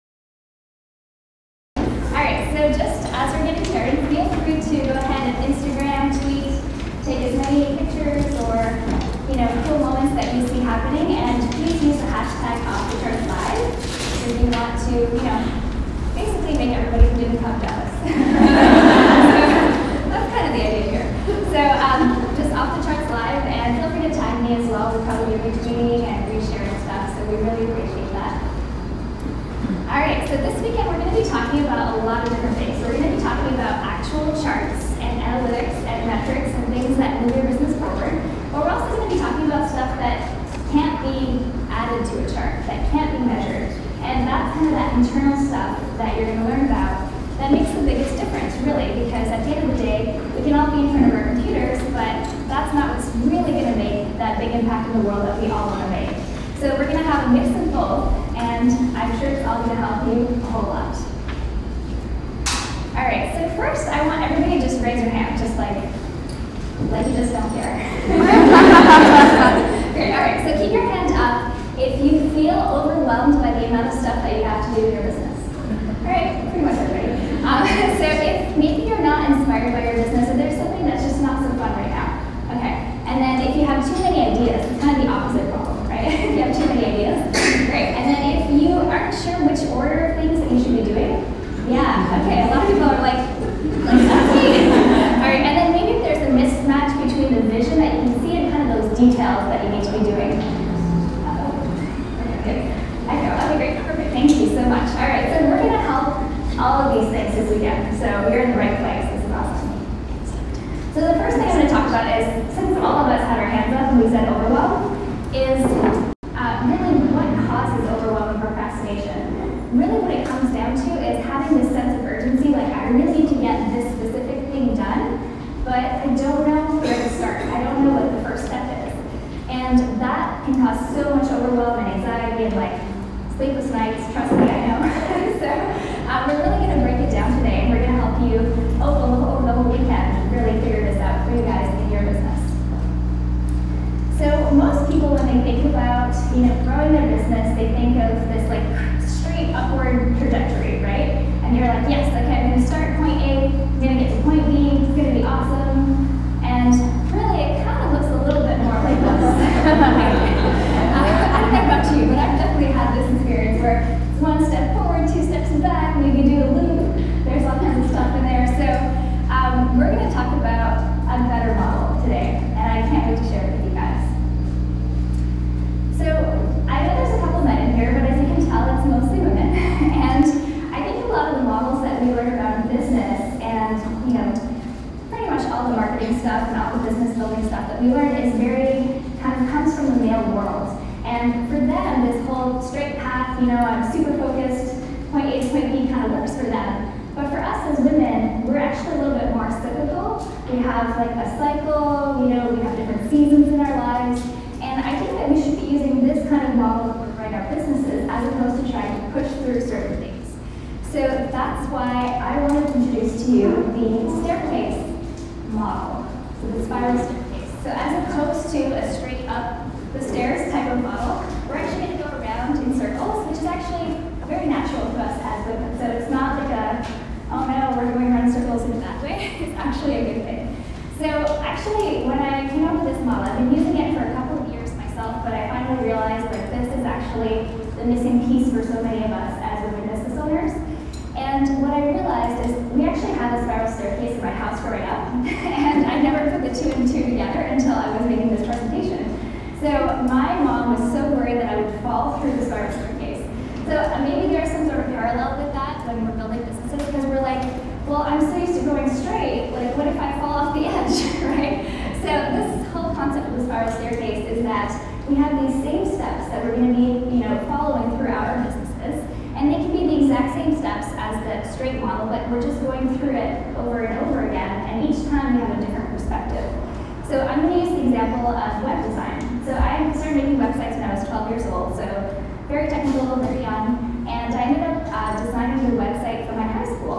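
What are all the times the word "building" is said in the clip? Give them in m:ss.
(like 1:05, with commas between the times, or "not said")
3:07, 4:16.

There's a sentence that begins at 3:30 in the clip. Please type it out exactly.
So that's why I wanted to introduce to you the staircase model, so the spiral staircase.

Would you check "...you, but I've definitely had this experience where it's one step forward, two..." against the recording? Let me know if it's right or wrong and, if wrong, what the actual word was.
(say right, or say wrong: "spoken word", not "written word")
right.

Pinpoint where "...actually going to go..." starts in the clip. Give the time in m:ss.
3:41.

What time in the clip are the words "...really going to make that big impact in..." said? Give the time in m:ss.
0:53.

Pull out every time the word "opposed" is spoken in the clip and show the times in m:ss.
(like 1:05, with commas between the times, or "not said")
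3:28, 3:38.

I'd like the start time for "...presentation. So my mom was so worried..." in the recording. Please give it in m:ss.
4:08.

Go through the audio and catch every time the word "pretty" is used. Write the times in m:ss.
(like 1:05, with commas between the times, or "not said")
1:16, 3:05.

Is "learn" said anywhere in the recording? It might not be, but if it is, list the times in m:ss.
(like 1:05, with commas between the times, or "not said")
0:46, 3:02, 3:07.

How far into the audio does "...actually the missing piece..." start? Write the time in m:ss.
3:57.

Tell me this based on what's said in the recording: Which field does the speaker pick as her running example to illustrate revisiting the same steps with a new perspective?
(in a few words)
web design.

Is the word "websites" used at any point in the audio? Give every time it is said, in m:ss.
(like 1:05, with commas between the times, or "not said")
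4:40, 4:45.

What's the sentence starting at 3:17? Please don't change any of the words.
But for us as women, we're actually a little bit more cyclical.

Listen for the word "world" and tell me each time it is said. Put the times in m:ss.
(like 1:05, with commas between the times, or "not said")
0:55, 3:10.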